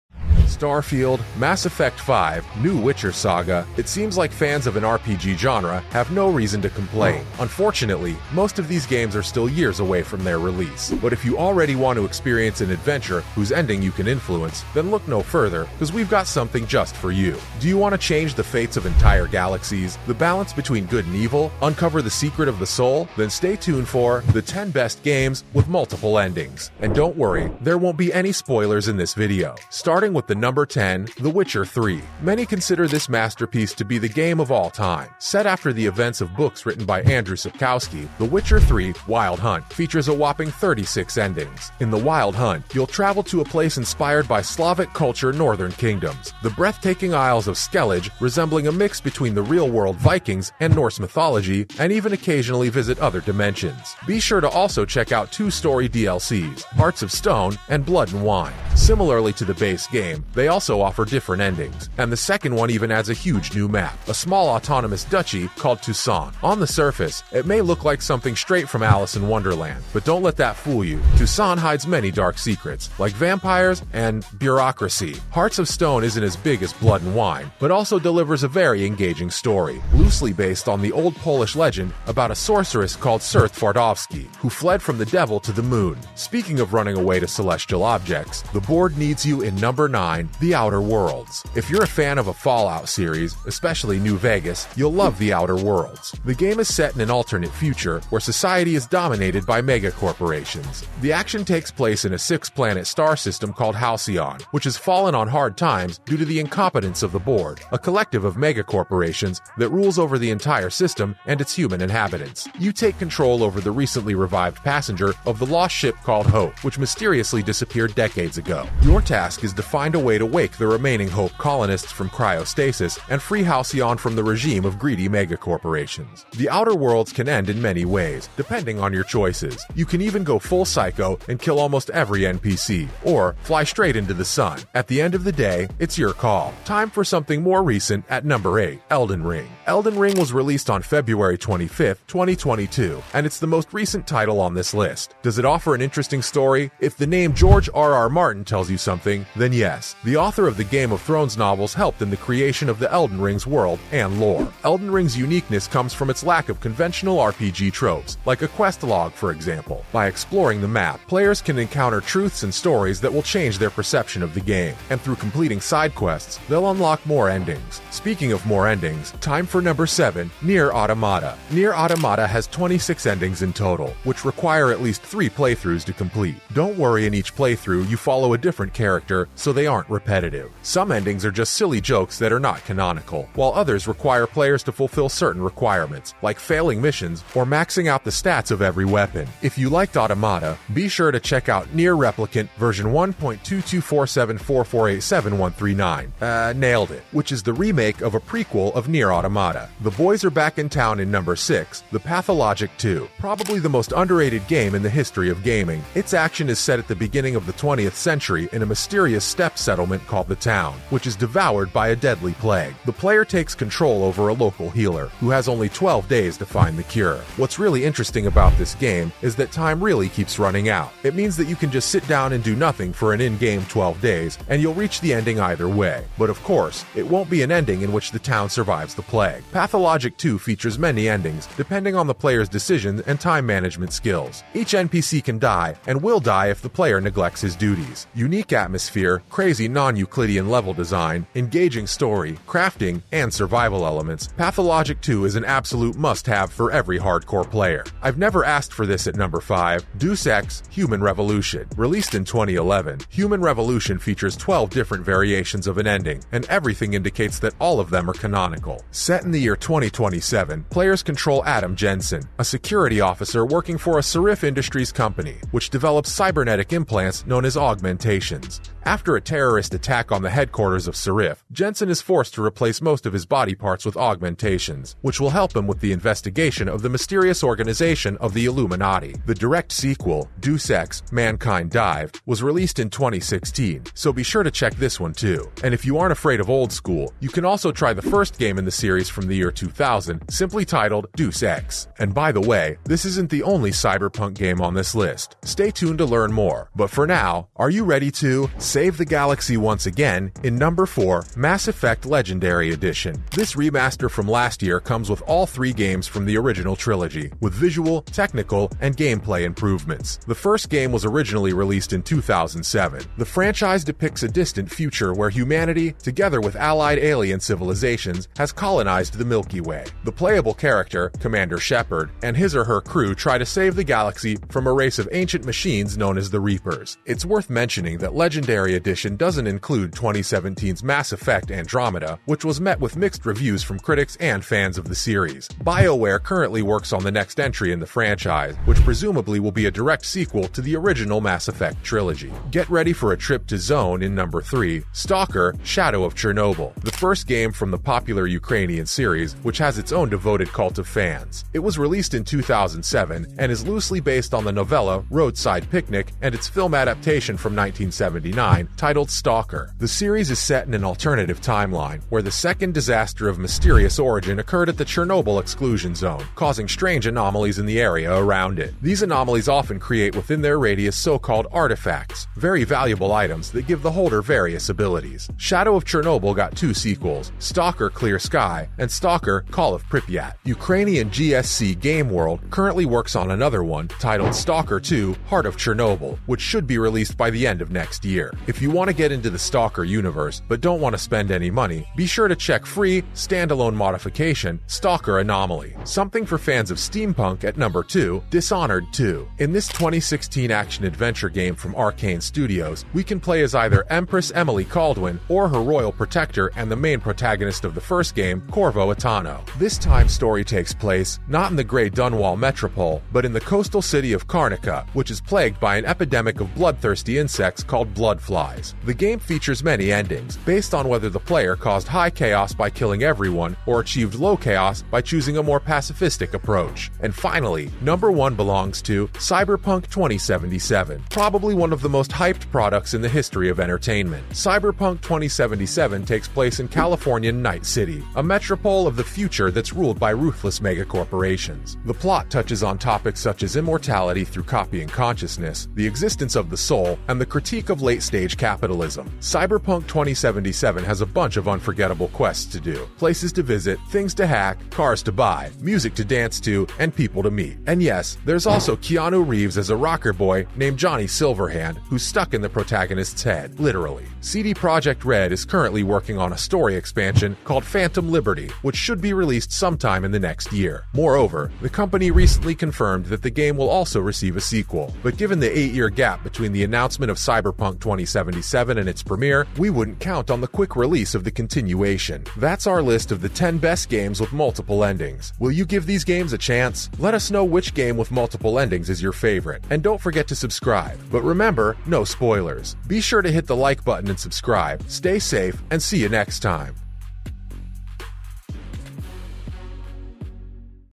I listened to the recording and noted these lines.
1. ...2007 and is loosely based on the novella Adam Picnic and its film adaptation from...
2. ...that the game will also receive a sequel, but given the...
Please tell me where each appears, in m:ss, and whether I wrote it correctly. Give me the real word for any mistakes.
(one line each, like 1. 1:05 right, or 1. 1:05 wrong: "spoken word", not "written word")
1. 5:52 wrong: "Roadside", not "Adam"
2. 7:53 right.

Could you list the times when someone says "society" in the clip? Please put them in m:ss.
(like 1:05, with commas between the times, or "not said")
1:38.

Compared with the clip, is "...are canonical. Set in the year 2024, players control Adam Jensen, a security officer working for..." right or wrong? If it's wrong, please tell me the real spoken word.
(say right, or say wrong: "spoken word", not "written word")
wrong: "2027", not "2024".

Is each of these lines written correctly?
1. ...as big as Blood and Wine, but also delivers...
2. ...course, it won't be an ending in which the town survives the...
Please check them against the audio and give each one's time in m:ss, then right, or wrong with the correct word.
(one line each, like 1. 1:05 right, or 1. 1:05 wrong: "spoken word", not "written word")
1. 1:16 right
2. 3:46 right.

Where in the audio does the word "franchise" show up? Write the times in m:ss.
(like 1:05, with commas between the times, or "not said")
5:13, 5:37.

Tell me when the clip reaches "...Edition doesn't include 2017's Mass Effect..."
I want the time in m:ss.
5:28.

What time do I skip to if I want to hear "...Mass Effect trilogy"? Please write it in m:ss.
5:41.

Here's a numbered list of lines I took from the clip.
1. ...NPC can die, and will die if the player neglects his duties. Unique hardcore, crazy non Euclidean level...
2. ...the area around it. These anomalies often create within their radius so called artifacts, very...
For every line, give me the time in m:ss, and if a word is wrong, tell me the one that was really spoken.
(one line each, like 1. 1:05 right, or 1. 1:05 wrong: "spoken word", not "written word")
1. 3:54 wrong: "atmosphere", not "hardcore"
2. 6:07 right.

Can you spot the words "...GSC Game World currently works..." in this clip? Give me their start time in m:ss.
6:21.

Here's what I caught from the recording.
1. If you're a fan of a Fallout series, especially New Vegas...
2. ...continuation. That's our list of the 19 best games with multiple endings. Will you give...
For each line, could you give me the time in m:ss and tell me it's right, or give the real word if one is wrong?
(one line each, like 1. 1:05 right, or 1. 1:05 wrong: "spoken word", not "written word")
1. 1:31 right
2. 8:01 wrong: "10", not "19".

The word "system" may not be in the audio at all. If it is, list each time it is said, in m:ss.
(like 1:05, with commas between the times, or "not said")
1:43, 1:50.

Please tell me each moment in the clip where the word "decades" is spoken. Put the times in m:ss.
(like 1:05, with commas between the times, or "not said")
1:57.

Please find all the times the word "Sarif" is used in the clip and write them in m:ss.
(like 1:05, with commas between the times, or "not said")
4:24, 4:30.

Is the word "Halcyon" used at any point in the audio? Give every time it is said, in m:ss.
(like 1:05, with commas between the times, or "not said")
1:43, 2:03.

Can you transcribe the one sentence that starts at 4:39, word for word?
The direct sequel, Deus Ex, Mankind Divided, was released in 2016, so be sure to check this one too.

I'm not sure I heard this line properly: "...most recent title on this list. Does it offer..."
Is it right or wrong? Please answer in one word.
right.